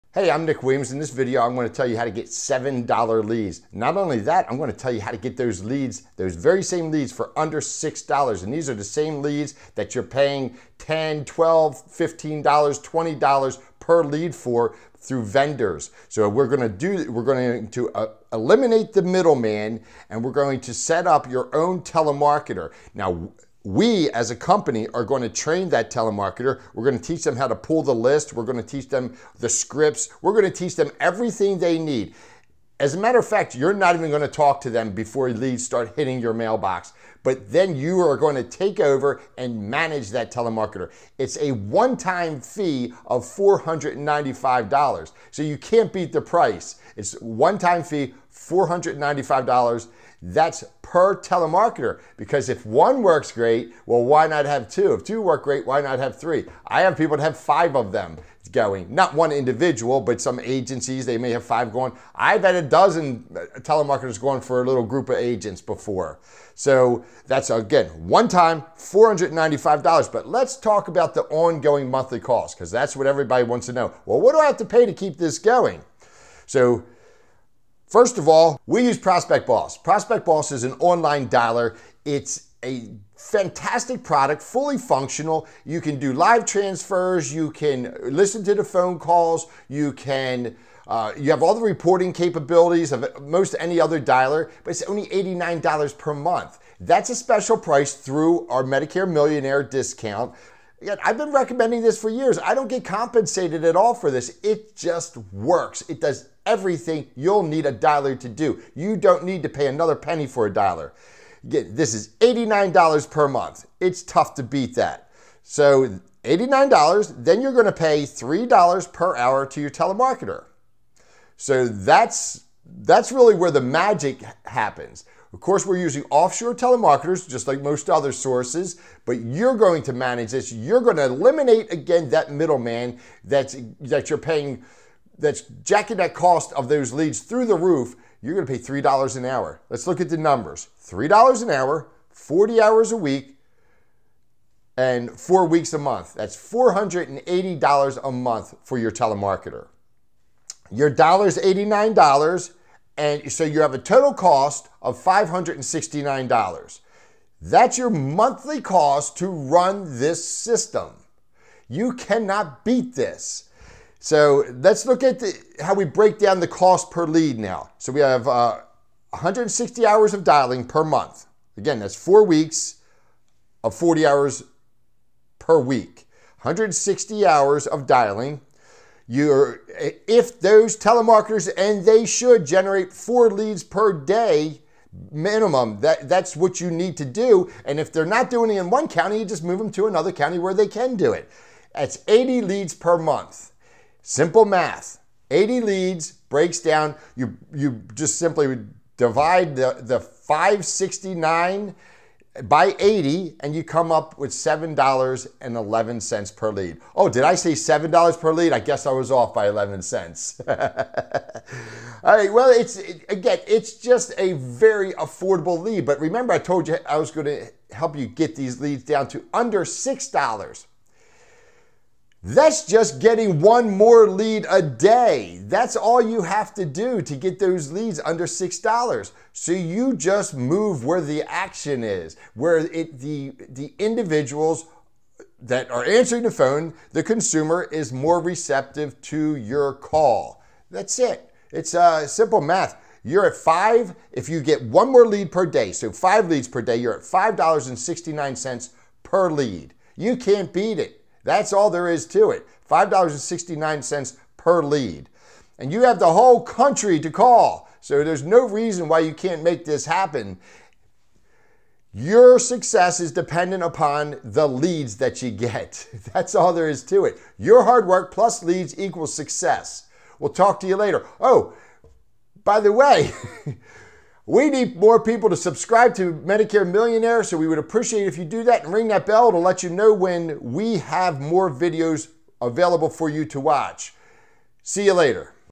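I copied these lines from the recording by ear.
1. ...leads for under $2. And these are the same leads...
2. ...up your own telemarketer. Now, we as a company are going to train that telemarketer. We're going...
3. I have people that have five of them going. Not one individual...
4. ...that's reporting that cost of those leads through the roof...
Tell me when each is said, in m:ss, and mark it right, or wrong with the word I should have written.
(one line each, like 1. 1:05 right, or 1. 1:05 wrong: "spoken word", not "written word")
1. 0:06 wrong: "6", not "2"
2. 0:21 right
3. 0:56 right
4. 2:15 wrong: "jacking", not "reporting".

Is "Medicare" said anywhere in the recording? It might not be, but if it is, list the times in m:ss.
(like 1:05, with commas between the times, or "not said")
1:38, 4:36.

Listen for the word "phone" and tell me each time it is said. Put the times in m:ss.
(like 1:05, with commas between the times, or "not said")
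1:28, 3:56.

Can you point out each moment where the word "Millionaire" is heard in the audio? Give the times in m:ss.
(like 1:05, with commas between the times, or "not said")
1:39, 4:36.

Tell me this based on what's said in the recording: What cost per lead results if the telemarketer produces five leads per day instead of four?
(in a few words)
$5.69.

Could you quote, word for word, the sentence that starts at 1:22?
It's a fantastic product, fully functional.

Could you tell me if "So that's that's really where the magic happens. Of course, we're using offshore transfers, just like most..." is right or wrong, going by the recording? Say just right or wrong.
wrong.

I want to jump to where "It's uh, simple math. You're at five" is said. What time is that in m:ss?
4:01.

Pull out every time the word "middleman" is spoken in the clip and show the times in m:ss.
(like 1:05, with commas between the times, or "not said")
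0:19, 2:12.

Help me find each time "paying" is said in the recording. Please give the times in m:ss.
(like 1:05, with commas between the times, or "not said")
0:10, 2:14.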